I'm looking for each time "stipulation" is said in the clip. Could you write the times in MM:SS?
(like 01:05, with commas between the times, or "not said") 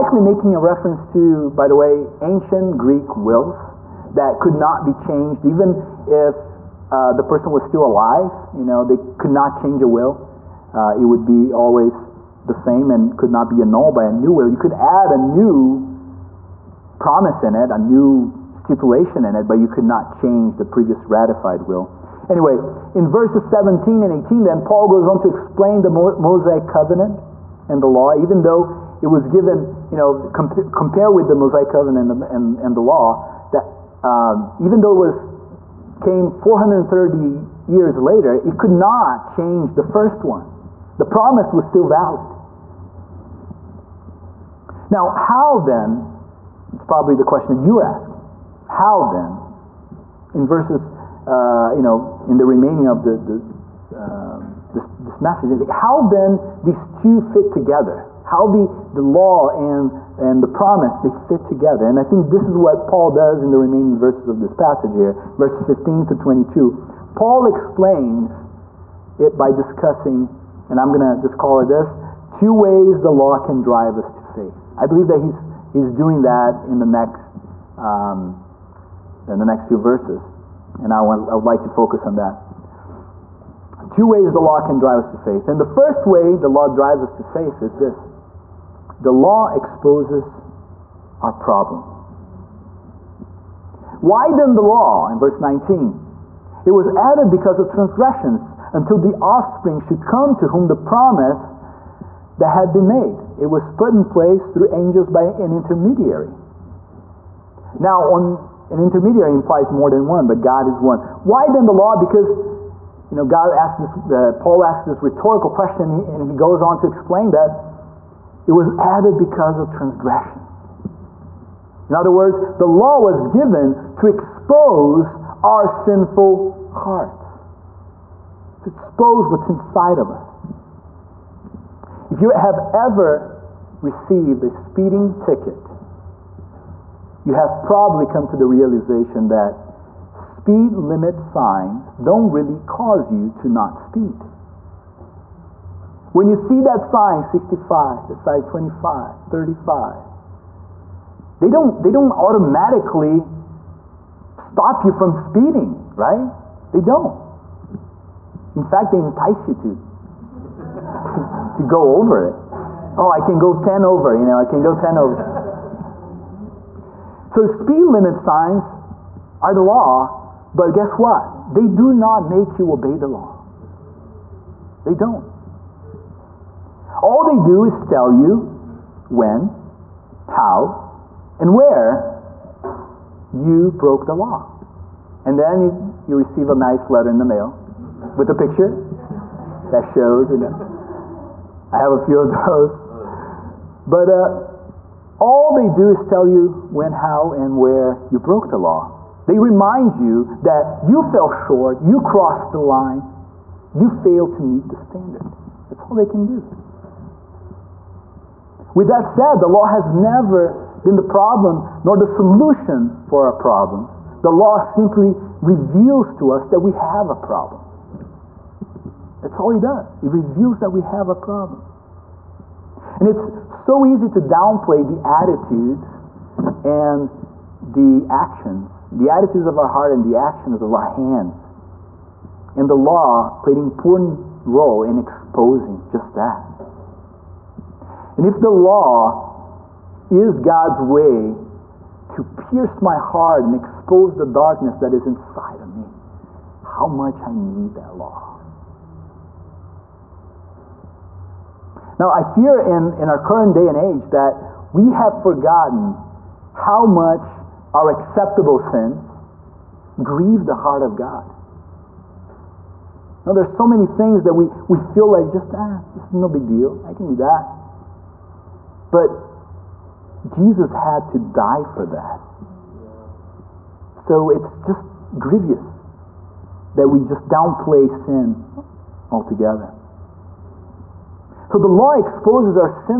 00:18.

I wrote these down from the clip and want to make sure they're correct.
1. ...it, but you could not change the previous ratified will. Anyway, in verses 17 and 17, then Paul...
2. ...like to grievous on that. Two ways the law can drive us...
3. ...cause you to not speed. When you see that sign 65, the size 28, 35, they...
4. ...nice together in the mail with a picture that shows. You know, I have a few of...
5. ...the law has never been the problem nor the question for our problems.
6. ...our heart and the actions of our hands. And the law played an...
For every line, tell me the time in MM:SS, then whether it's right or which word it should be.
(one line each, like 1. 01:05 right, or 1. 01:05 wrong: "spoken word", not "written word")
1. 00:19 wrong: "18", not "17"
2. 01:21 wrong: "focus", not "grievous"
3. 02:22 wrong: "25", not "28"
4. 03:06 wrong: "letter", not "together"
5. 03:29 wrong: "solution", not "question"
6. 03:49 right.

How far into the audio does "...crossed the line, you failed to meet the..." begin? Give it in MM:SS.
03:22.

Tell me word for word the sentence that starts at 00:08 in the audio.
You know, they could not change a will.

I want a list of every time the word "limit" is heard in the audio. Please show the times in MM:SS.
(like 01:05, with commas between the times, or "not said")
02:20, 02:47.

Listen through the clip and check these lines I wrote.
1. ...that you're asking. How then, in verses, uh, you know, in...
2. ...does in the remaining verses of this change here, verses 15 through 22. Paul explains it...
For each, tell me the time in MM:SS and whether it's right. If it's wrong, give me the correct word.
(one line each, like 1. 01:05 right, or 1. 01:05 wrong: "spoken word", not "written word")
1. 00:47 right
2. 01:03 wrong: "passage", not "change".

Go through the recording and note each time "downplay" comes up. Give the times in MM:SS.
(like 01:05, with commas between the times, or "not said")
03:44, 04:37.